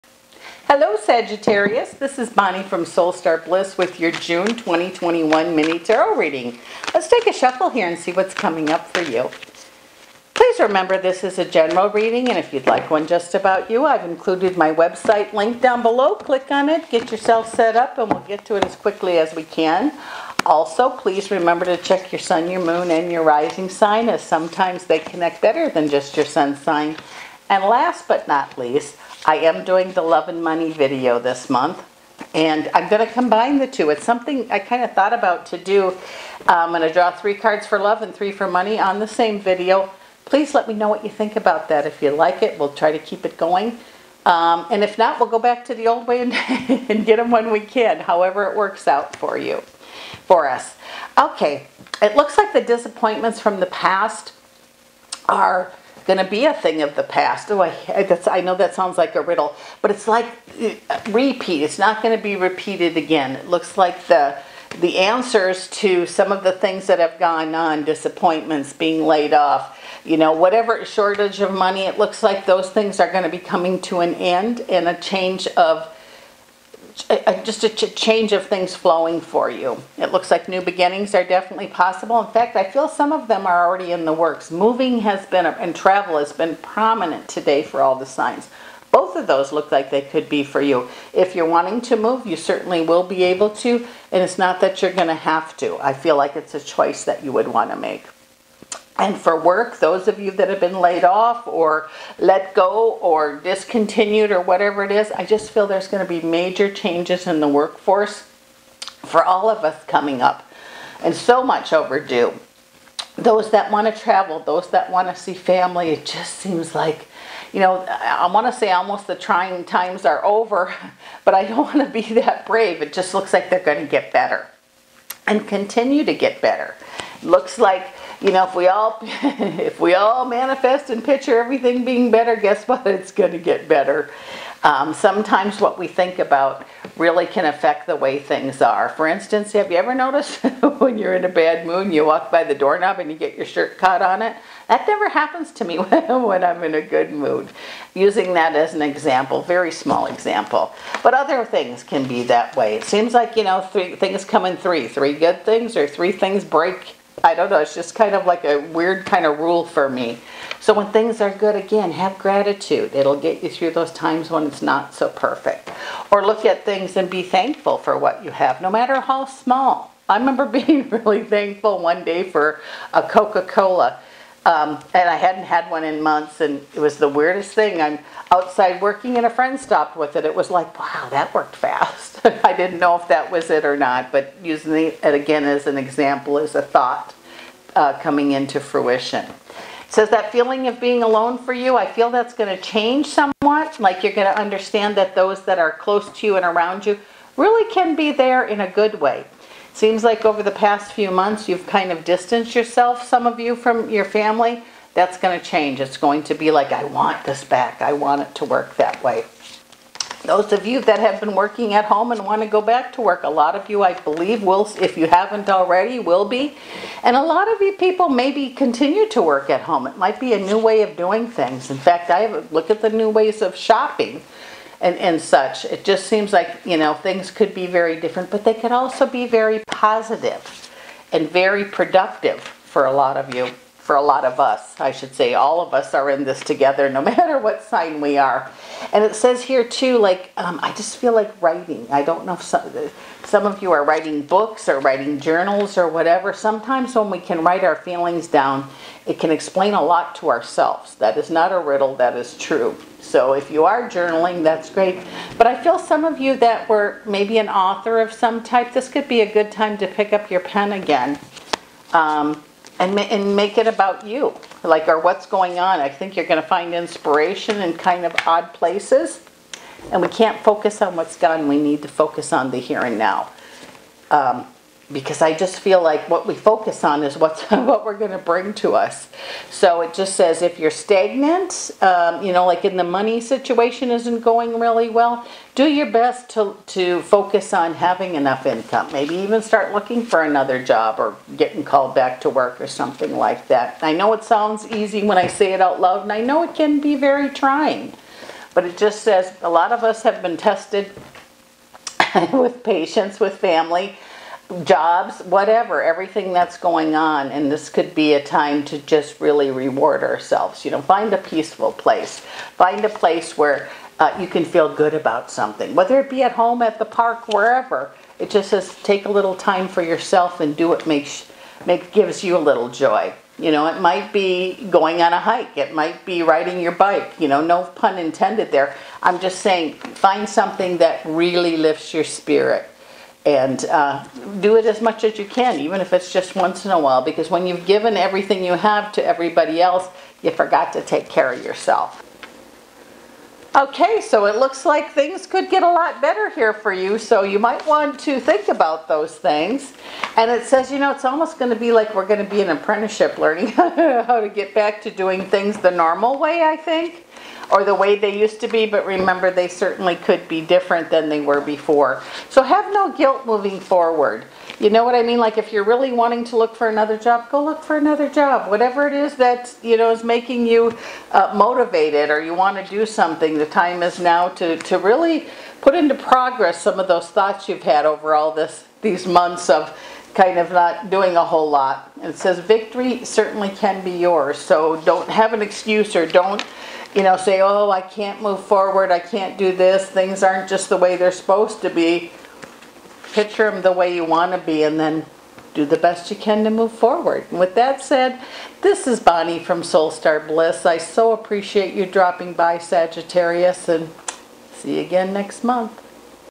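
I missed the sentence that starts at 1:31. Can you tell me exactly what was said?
If you're wanting to move, you certainly will be able to, and it's not that you're going to have to.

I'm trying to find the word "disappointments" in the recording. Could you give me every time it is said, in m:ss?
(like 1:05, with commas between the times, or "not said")
0:52, 1:07.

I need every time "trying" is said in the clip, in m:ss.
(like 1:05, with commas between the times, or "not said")
1:59, 4:57.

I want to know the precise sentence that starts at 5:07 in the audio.
And this could be a time to just really reward ourselves.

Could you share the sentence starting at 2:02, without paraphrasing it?
It just looks like they're going to get better and continue to get better.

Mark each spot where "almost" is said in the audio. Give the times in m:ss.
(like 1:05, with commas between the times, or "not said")
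1:58, 5:51.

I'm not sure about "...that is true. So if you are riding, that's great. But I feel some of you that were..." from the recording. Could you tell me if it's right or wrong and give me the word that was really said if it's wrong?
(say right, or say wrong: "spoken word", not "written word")
wrong: "journaling", not "riding".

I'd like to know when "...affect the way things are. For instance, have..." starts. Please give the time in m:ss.
2:17.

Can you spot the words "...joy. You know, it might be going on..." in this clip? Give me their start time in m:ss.
5:22.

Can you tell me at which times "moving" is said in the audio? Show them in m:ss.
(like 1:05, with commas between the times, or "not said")
1:24, 6:03.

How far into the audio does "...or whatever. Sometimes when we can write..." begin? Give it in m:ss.
4:05.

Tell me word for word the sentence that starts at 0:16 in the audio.
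Click on it, get yourself set up and we'll get to it as quickly as we can.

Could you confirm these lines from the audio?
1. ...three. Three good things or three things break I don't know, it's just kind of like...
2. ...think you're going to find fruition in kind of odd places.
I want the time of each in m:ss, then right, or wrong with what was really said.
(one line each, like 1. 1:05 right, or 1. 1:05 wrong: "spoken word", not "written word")
1. 2:34 right
2. 4:25 wrong: "inspiration", not "fruition".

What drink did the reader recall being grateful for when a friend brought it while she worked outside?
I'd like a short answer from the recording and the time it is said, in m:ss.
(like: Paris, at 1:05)
Coca-Cola, at 2:53.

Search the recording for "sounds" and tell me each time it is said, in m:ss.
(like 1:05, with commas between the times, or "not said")
0:58, 4:54.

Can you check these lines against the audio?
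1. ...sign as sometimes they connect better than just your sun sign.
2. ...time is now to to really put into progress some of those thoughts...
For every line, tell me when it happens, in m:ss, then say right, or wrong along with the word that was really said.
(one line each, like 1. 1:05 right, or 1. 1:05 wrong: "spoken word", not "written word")
1. 0:23 right
2. 6:13 right.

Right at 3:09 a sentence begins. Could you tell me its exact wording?
It says that feeling of being alone for you, I feel that's going to change somewhat.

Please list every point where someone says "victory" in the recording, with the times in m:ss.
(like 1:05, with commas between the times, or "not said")
6:22.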